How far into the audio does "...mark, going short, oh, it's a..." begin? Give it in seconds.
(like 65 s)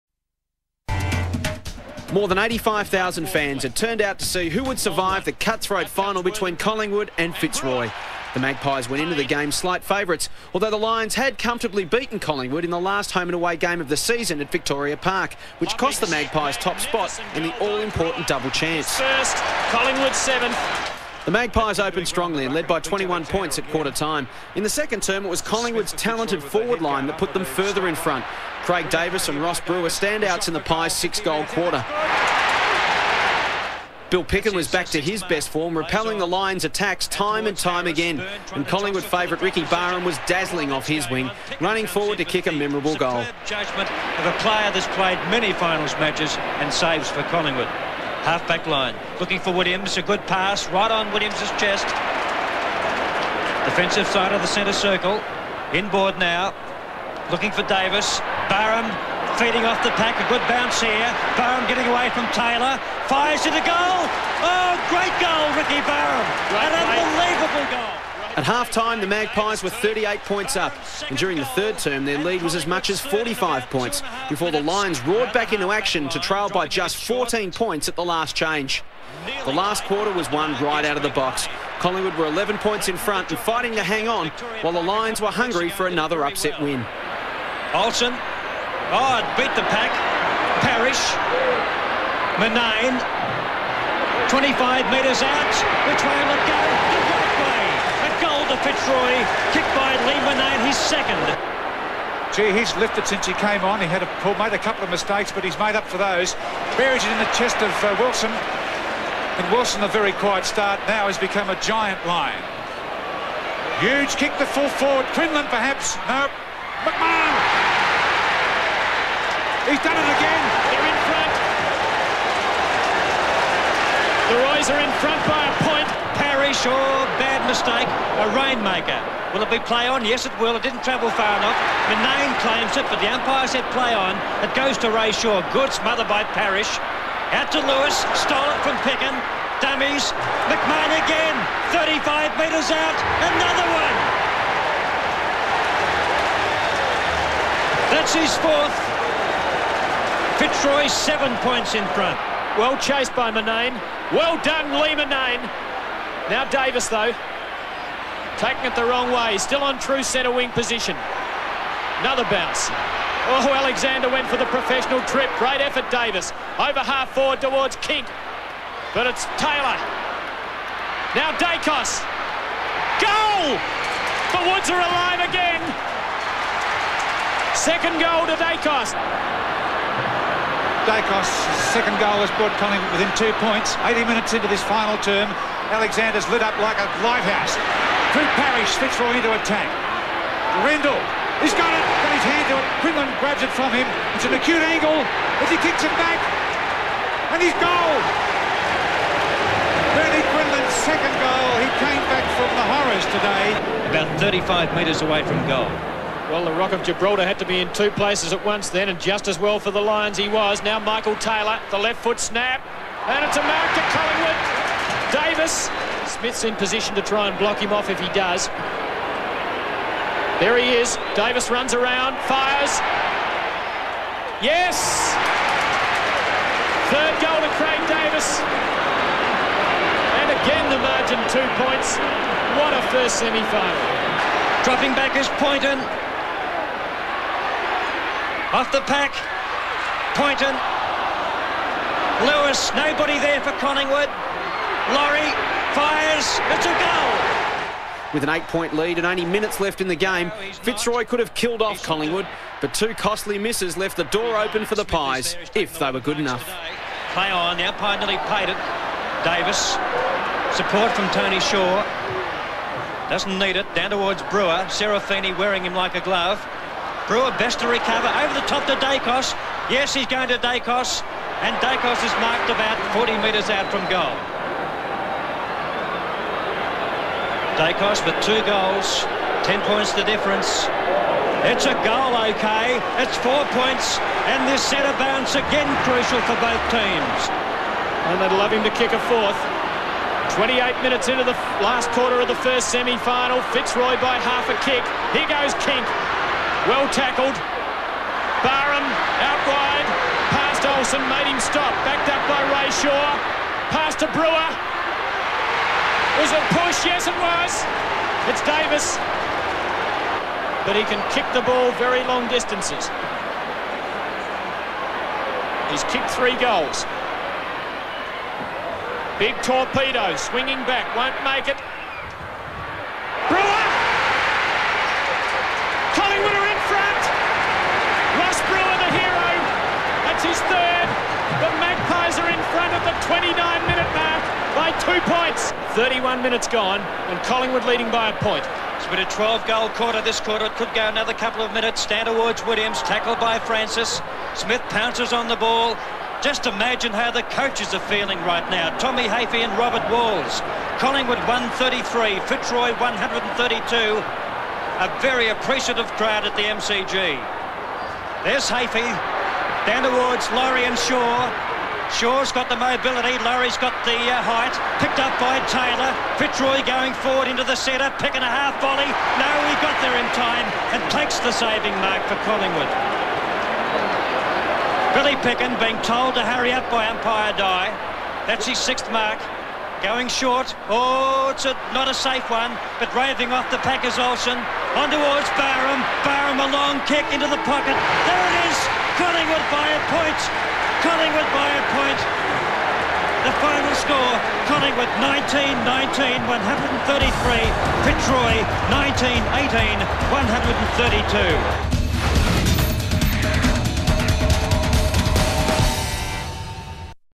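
378 s.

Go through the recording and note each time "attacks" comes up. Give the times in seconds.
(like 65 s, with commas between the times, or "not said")
36 s, 189 s.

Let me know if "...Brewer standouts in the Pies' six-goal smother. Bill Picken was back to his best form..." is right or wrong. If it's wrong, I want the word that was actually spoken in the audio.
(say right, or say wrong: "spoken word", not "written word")
wrong: "quarter", not "smother".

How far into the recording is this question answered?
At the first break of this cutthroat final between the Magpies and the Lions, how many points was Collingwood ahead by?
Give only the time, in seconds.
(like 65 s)
22 s.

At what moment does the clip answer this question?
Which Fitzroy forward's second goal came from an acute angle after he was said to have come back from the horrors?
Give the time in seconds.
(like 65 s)
199 s.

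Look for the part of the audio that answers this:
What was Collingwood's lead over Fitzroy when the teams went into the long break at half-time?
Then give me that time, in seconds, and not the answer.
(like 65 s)
69 s.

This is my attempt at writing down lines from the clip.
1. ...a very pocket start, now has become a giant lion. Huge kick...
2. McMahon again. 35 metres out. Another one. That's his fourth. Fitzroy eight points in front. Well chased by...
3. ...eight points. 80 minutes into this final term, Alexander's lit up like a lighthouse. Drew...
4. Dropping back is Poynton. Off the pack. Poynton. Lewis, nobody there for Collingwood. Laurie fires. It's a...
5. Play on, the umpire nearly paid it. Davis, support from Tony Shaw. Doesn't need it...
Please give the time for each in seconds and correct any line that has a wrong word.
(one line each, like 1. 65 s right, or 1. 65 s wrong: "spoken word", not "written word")
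1. 109 s wrong: "quiet", not "pocket"
2. 140 s wrong: "seven", not "eight"
3. 183 s wrong: "two", not "eight"
4. 234 s right
5. 257 s right.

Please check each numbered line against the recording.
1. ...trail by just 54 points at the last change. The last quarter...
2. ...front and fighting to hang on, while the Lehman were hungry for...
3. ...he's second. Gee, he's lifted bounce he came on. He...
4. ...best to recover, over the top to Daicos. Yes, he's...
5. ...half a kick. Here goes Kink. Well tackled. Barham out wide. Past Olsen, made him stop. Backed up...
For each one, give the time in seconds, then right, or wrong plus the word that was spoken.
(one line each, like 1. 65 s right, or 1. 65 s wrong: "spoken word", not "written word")
1. 76 s wrong: "14", not "54"
2. 82 s wrong: "Lions", not "Lehman"
3. 100 s wrong: "since", not "bounce"
4. 267 s right
5. 294 s right.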